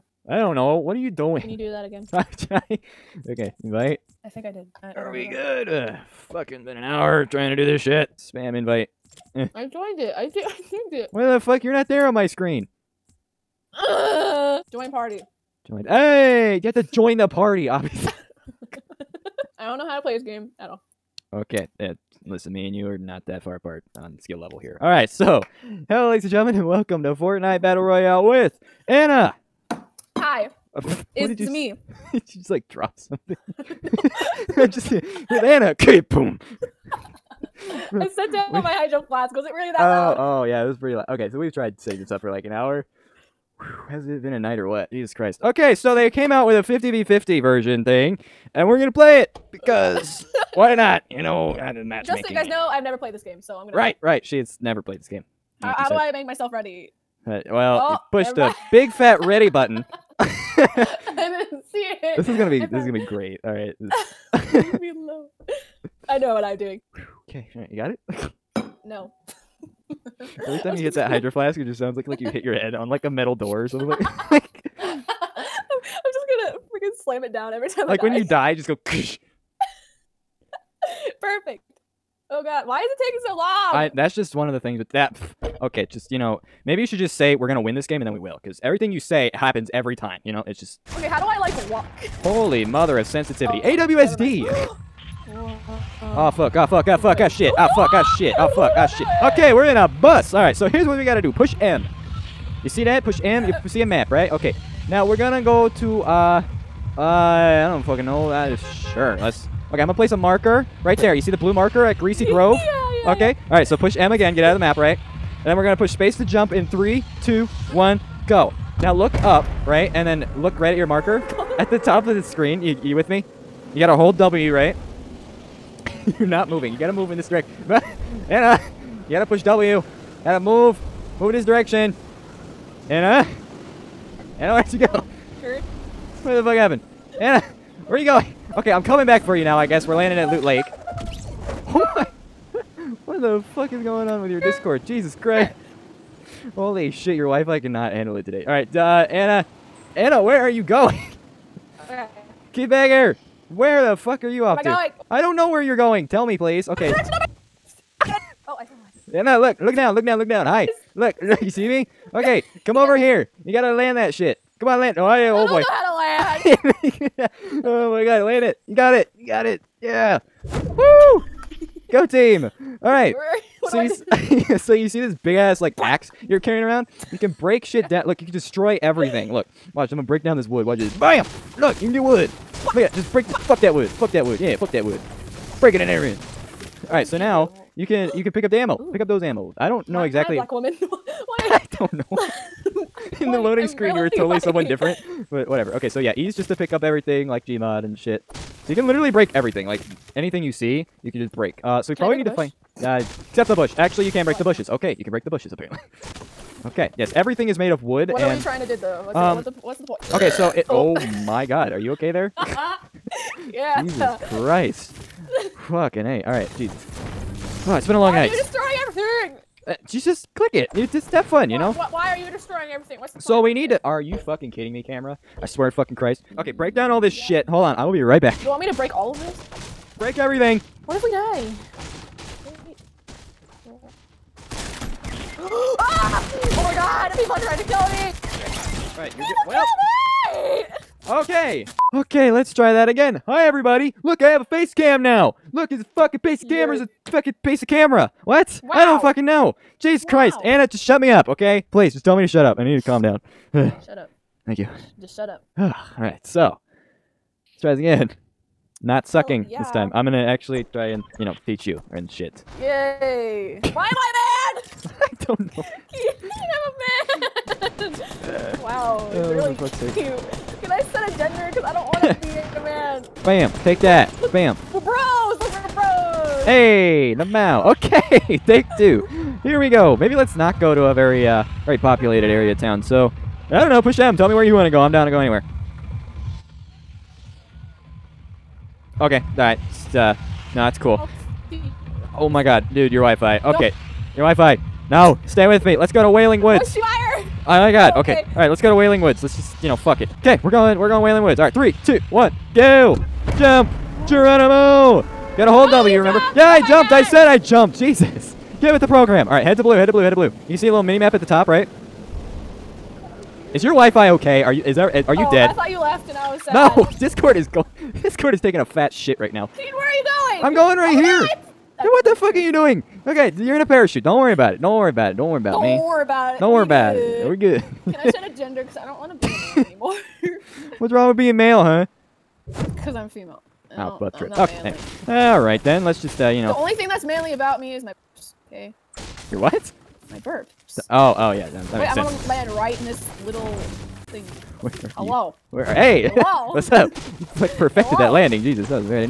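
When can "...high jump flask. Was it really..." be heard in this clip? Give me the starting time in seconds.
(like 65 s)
38 s.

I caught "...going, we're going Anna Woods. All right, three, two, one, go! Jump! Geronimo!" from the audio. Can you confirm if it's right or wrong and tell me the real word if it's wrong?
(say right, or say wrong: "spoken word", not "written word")
wrong: "Wailing", not "Anna".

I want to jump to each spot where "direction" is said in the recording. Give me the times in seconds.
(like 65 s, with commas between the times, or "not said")
127 s, 131 s.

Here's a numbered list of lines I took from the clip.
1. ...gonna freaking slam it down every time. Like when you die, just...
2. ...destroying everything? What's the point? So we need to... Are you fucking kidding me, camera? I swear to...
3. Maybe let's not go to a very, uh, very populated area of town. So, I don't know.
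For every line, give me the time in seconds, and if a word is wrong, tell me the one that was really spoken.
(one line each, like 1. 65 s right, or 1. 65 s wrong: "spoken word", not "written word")
1. 76 s right
2. 222 s right
3. 279 s right.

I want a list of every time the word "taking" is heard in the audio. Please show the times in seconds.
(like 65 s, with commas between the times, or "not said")
83 s, 318 s.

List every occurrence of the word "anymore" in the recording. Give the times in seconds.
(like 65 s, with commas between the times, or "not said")
329 s.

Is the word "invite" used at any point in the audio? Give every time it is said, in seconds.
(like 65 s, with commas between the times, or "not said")
3 s, 8 s.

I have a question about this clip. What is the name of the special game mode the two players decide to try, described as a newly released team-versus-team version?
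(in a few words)
50v50.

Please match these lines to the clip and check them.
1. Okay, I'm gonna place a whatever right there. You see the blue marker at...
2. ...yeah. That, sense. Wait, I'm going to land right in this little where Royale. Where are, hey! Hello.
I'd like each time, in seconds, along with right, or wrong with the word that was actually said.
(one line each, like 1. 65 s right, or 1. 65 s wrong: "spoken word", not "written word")
1. 109 s wrong: "marker", not "whatever"
2. 341 s wrong: "Hello", not "Royale".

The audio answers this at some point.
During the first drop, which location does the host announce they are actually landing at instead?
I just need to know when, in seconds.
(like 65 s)
140 s.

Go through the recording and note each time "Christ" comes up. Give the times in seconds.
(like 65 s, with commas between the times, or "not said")
45 s, 145 s, 214 s, 225 s, 250 s.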